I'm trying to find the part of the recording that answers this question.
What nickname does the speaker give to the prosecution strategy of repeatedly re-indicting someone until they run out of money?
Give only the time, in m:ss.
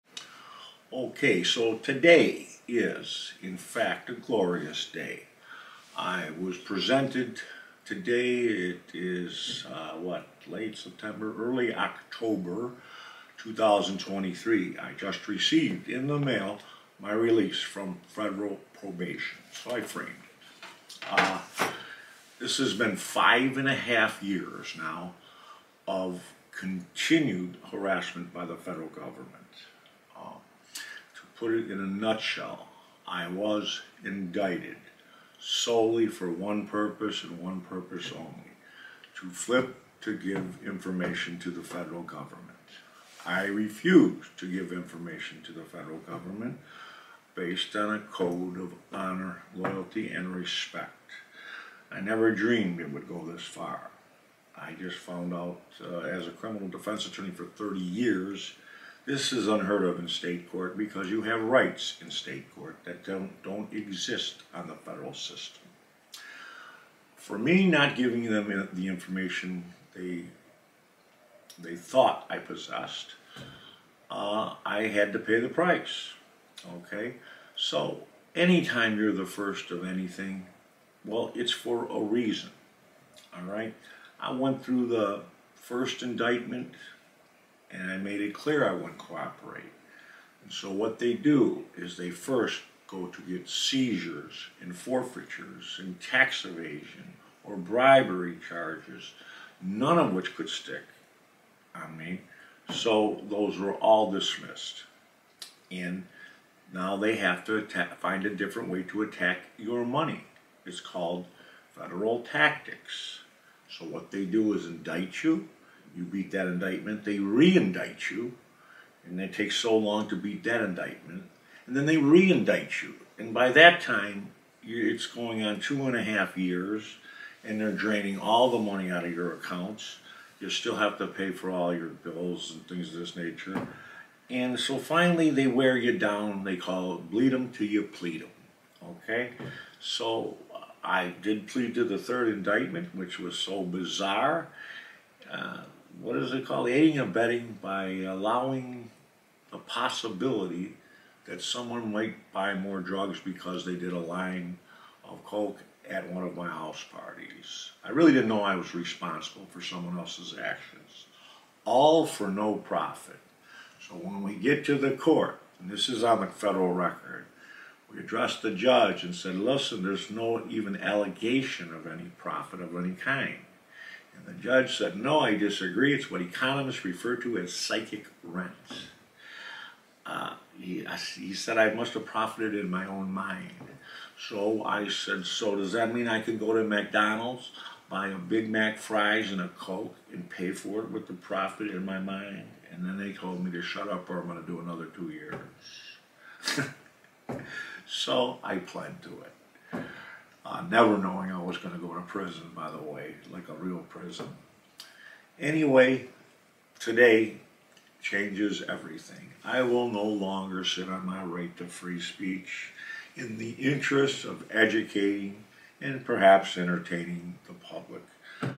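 2:17.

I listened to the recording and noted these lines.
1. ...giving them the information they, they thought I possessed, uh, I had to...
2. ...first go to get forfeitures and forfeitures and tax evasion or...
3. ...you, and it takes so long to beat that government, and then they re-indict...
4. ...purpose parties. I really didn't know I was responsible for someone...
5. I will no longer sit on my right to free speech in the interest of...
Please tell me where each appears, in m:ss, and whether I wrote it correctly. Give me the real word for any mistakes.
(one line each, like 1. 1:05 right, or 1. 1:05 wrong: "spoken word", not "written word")
1. 1:07 right
2. 1:32 wrong: "seizures", not "forfeitures"
3. 1:58 wrong: "indictment", not "government"
4. 2:36 wrong: "house", not "purpose"
5. 3:29 right.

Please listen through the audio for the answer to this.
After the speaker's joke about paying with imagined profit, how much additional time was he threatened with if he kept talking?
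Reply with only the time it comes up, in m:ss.
3:14.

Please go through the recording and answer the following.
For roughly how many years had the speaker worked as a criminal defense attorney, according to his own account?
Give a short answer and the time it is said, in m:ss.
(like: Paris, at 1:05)
30 years, at 0:57.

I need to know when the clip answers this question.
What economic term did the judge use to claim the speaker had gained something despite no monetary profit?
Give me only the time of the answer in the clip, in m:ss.
2:57.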